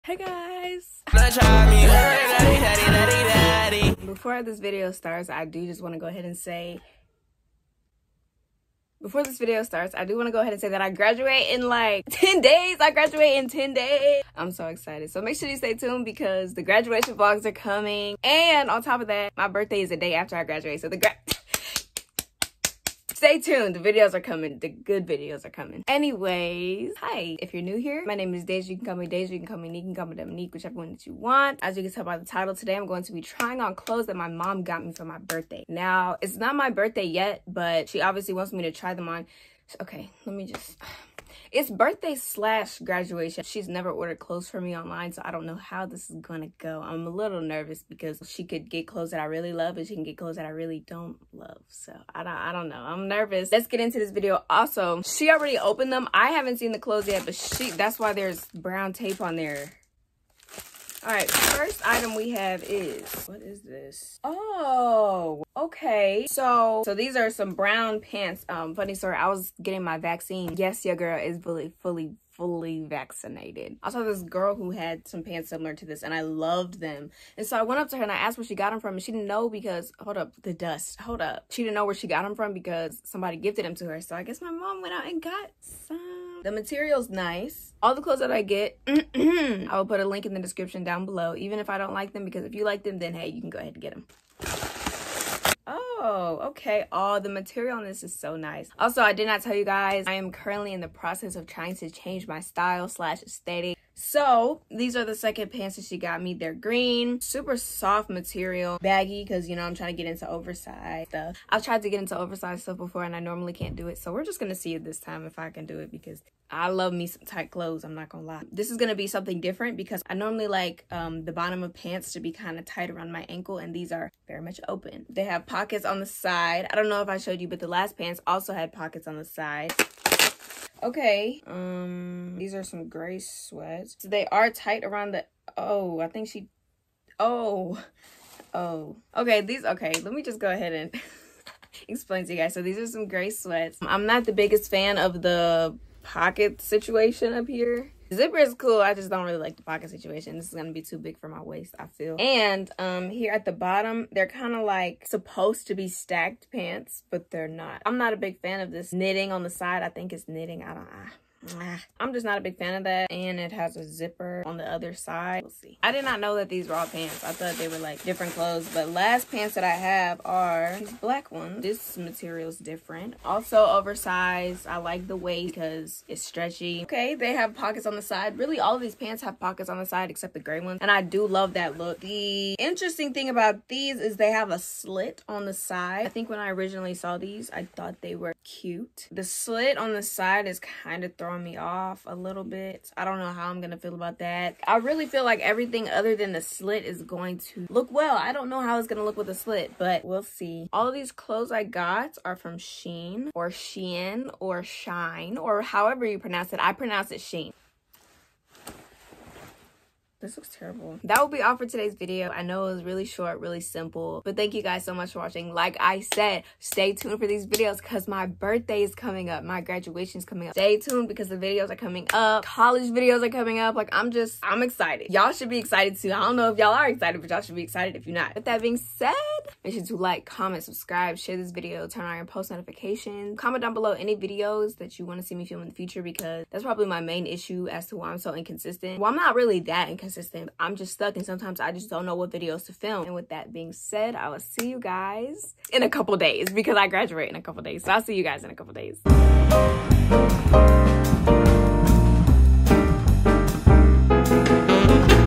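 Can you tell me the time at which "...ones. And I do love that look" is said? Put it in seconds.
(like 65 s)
180 s.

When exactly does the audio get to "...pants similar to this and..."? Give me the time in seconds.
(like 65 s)
75 s.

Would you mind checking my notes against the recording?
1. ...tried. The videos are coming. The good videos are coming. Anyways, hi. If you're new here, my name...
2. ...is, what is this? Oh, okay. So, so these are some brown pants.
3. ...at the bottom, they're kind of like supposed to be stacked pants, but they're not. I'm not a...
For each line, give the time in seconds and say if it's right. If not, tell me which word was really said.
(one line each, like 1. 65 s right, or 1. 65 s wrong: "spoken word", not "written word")
1. 23 s wrong: "tuned", not "tried"
2. 62 s right
3. 153 s right.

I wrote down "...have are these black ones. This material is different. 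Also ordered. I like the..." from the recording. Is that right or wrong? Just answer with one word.
wrong.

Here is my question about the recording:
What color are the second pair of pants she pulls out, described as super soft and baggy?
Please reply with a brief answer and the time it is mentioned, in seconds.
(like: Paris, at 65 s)
Green, at 106 s.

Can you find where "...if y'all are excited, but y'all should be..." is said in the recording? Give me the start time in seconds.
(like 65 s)
226 s.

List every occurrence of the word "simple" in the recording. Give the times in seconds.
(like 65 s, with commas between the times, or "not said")
213 s.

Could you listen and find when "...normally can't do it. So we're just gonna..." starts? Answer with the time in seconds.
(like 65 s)
113 s.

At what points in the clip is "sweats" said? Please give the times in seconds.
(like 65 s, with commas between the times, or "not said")
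133 s, 143 s.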